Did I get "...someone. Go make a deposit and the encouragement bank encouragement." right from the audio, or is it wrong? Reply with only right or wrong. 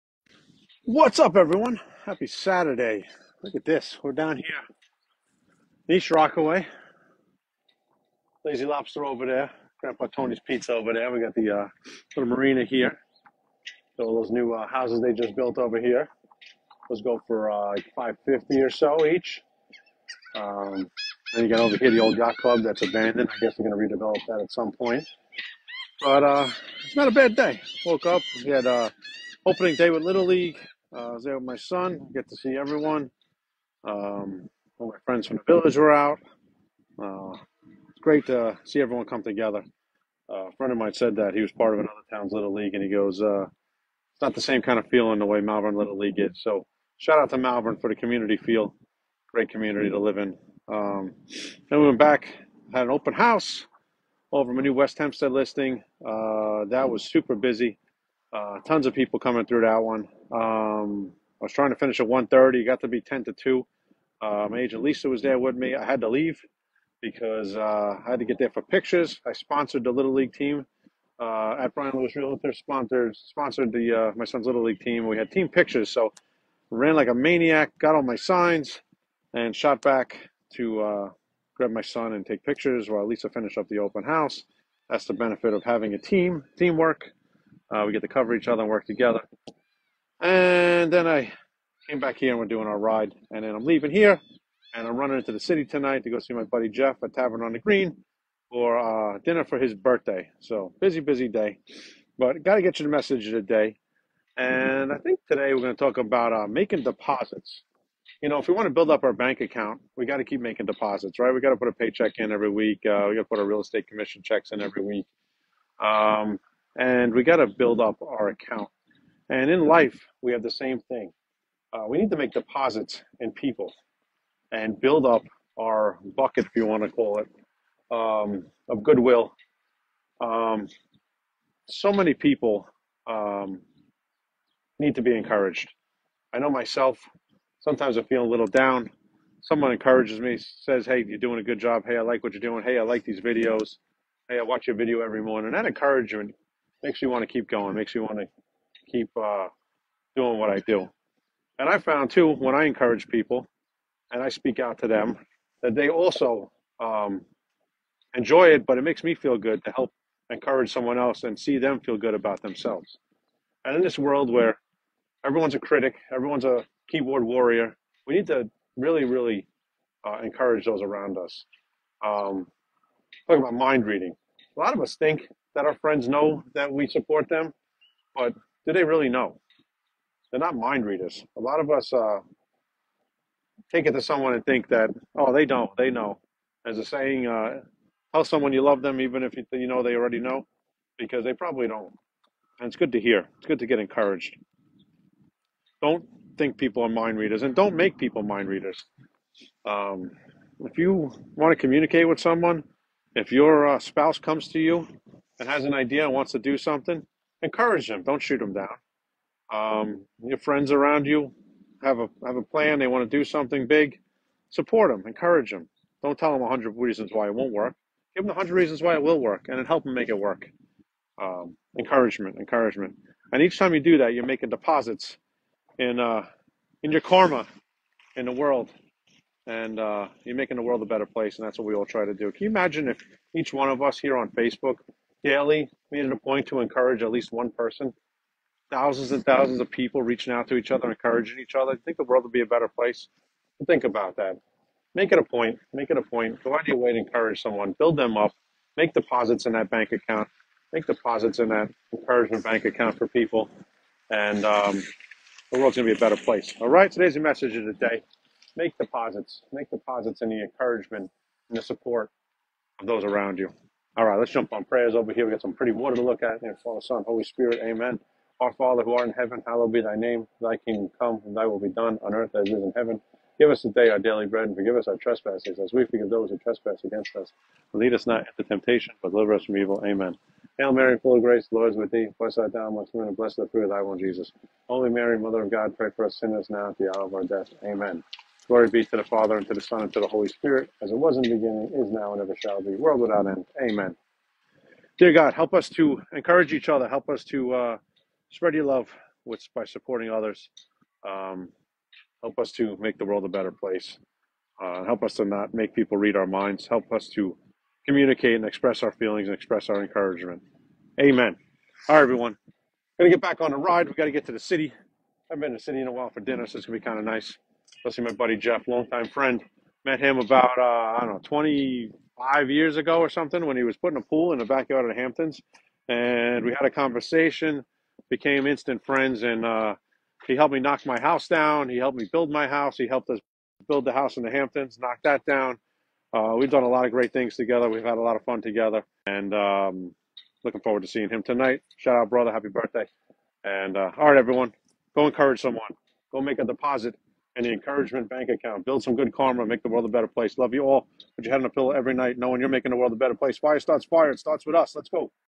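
wrong.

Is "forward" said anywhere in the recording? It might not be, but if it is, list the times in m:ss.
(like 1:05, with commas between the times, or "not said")
5:40.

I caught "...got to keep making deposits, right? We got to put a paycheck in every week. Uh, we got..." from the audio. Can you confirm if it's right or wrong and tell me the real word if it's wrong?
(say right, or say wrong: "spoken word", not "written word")
right.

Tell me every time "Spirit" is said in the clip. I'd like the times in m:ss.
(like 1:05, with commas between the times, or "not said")
4:27, 4:50.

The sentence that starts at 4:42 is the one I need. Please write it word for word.
Blessed art thou amongst women, and blessed the fruit of thy womb, Jesus.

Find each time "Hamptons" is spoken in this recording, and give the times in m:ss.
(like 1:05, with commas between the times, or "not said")
5:25, 5:34.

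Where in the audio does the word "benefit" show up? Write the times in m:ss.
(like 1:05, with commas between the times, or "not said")
1:25.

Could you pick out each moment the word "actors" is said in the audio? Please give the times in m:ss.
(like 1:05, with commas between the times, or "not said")
not said.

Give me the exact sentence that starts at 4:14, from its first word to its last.
And um, the world's going to be a better place.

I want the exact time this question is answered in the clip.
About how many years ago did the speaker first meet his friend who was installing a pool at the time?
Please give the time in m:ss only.
5:21.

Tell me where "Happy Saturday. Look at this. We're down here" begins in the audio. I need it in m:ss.
0:02.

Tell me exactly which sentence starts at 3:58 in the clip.
Thousands and thousands of people reaching out to each other, encouraging each other.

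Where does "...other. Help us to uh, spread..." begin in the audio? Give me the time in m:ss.
4:56.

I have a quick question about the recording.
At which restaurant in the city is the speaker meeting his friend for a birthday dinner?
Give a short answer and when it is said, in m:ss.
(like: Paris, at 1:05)
Tavern on the Green, at 1:37.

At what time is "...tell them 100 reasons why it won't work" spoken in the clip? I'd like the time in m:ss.
3:36.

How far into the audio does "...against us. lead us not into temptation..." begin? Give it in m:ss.
4:36.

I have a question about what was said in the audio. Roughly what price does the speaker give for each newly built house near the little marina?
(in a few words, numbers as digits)
550.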